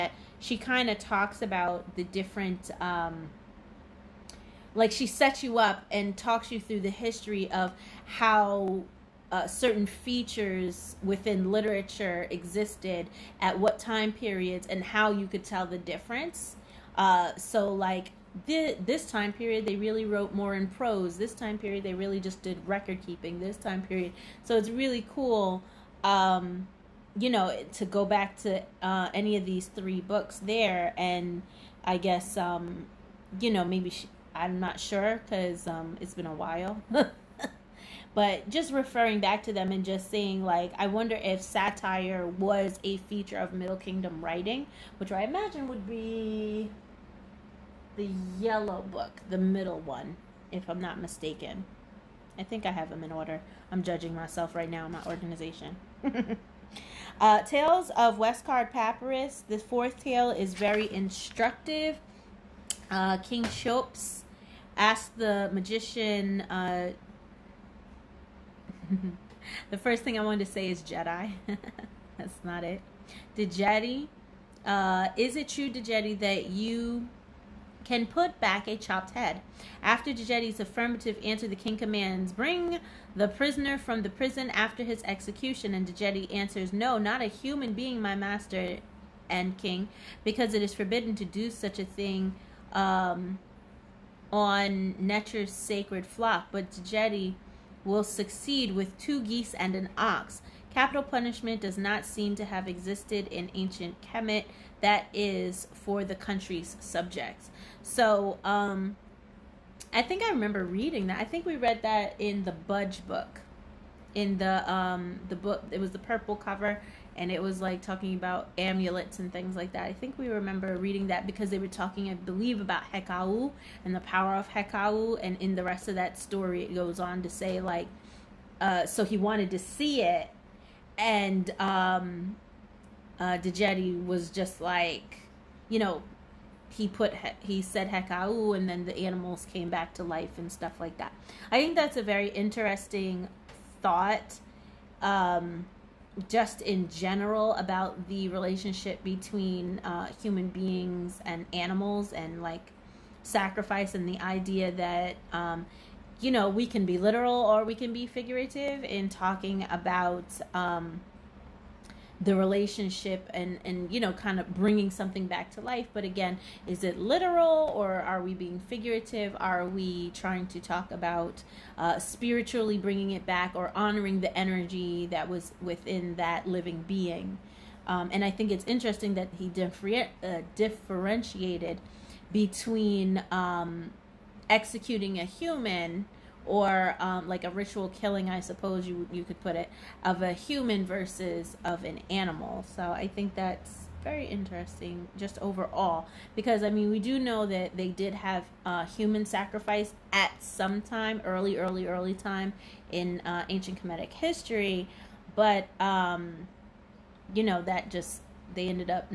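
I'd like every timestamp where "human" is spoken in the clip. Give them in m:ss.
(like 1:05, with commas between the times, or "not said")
1:27, 2:30, 3:05, 3:10, 3:18.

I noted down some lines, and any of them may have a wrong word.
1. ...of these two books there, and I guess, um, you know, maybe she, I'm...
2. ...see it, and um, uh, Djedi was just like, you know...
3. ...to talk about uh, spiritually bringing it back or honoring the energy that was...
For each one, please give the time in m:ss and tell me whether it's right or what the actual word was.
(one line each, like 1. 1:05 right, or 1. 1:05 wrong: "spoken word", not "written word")
1. 0:29 wrong: "three", not "two"
2. 2:09 right
3. 2:50 right.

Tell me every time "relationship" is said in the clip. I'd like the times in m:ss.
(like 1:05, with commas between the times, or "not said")
2:28, 2:42.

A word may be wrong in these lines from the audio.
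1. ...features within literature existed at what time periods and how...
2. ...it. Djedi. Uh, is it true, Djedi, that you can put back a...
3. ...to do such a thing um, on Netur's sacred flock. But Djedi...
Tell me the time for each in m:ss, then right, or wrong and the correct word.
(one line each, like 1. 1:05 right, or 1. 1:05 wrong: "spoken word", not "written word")
1. 0:09 right
2. 1:12 right
3. 1:31 right.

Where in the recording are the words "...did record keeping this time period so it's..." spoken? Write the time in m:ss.
0:22.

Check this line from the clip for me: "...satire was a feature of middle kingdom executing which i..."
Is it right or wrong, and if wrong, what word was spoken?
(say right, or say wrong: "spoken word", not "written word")
wrong: "writing", not "executing".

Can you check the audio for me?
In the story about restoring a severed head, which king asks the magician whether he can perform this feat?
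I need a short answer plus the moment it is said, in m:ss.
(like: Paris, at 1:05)
King Cheops, at 1:03.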